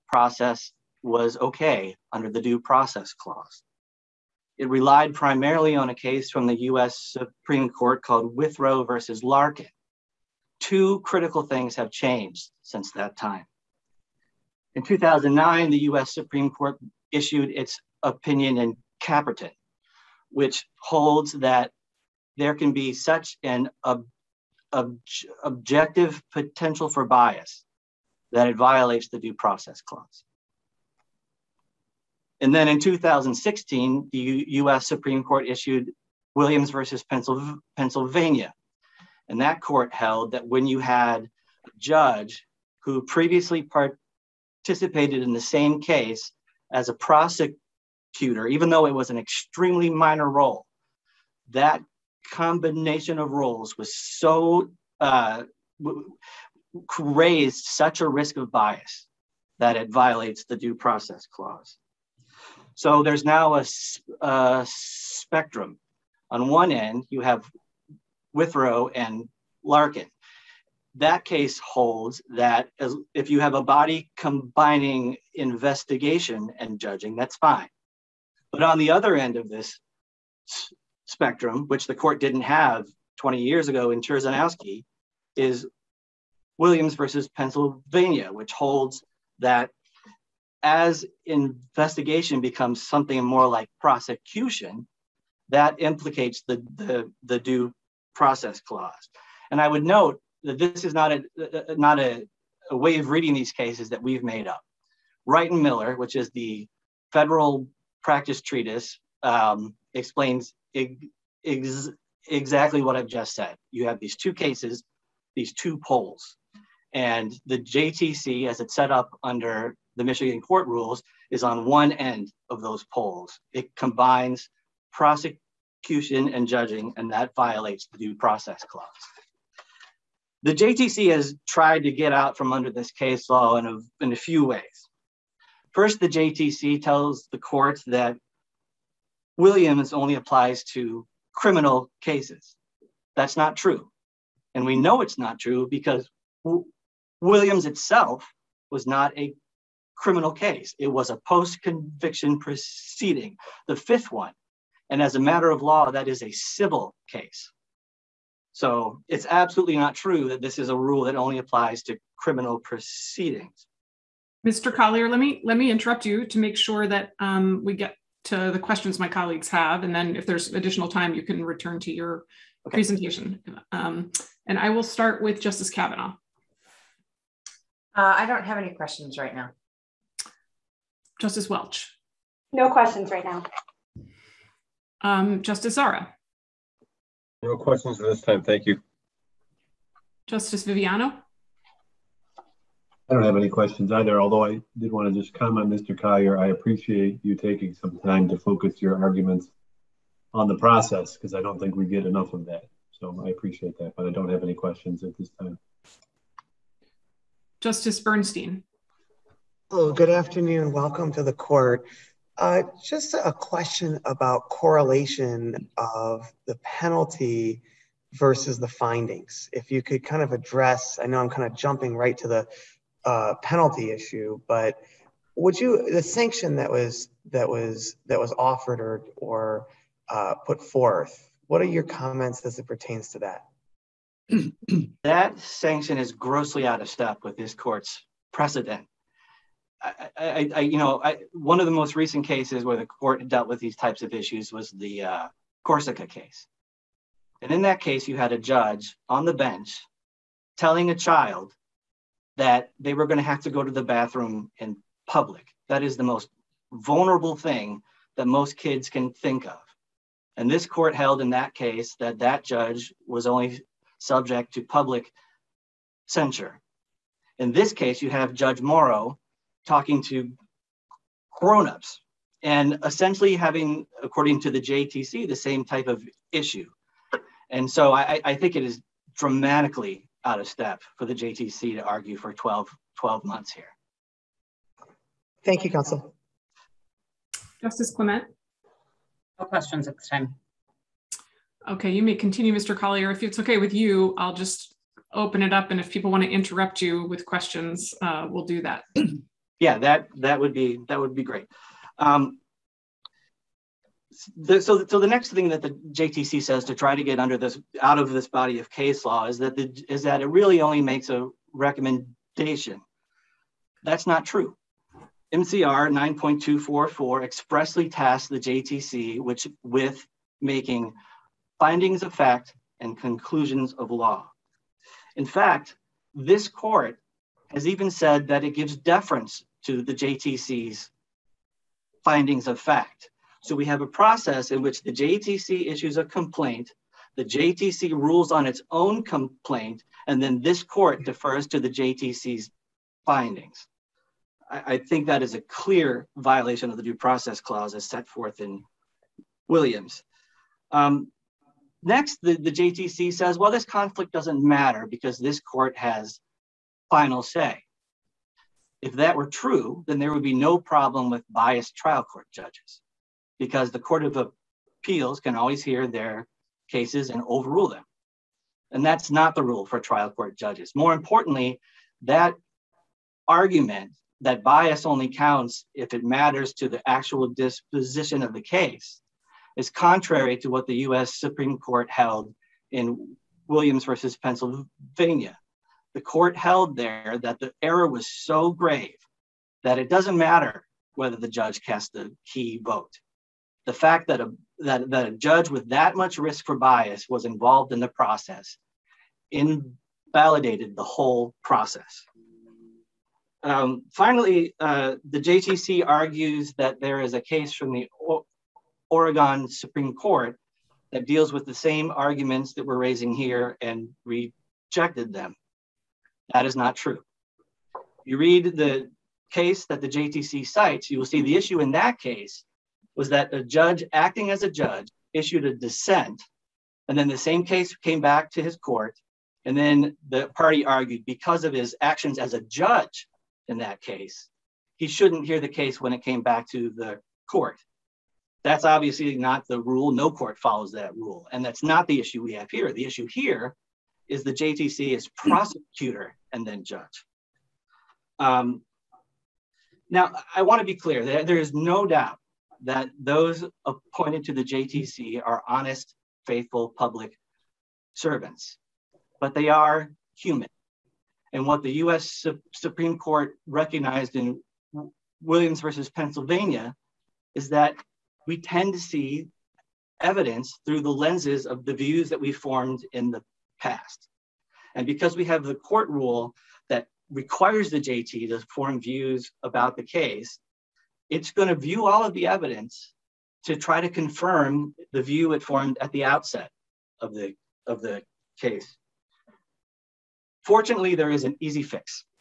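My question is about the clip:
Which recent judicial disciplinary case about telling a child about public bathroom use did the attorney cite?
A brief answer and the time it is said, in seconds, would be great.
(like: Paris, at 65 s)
Corsica, at 245 s.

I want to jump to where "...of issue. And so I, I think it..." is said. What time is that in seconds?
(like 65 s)
275 s.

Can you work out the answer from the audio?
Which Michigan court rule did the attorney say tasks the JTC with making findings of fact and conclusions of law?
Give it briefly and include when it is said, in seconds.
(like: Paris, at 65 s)
MCR 9.244, at 315 s.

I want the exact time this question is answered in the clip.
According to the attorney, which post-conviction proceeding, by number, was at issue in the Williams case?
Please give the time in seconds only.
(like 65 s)
153 s.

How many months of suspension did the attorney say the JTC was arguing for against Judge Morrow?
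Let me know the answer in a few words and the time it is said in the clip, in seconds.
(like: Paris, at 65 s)
12, at 282 s.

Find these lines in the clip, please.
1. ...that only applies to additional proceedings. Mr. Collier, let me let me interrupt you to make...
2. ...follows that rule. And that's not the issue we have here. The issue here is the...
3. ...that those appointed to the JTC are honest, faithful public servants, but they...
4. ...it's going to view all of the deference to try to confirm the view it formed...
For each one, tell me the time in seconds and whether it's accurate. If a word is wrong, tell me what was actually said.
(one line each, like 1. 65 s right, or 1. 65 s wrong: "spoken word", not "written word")
1. 161 s wrong: "criminal", not "additional"
2. 440 s right
3. 452 s right
4. 481 s wrong: "evidence", not "deference".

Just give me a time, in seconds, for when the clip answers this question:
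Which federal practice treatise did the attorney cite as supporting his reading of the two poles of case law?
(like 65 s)
105 s.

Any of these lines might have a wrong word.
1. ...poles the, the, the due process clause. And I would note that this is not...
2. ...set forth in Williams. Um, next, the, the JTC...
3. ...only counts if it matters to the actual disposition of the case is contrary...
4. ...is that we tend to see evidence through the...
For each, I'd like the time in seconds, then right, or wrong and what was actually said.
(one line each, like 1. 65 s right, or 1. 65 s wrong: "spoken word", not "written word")
1. 95 s wrong: "implicates", not "poles"
2. 347 s right
3. 374 s right
4. 467 s right.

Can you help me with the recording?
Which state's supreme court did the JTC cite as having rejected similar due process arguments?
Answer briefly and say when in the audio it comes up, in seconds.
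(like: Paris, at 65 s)
Oregon, at 408 s.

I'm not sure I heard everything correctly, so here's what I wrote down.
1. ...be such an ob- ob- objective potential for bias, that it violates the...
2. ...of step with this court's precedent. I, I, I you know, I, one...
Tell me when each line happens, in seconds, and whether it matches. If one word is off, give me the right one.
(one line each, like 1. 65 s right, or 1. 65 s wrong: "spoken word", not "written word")
1. 22 s right
2. 236 s right.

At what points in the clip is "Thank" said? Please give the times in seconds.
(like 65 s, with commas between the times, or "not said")
188 s, 285 s.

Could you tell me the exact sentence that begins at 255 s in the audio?
That is the most vulnerable thing that most kids can think of.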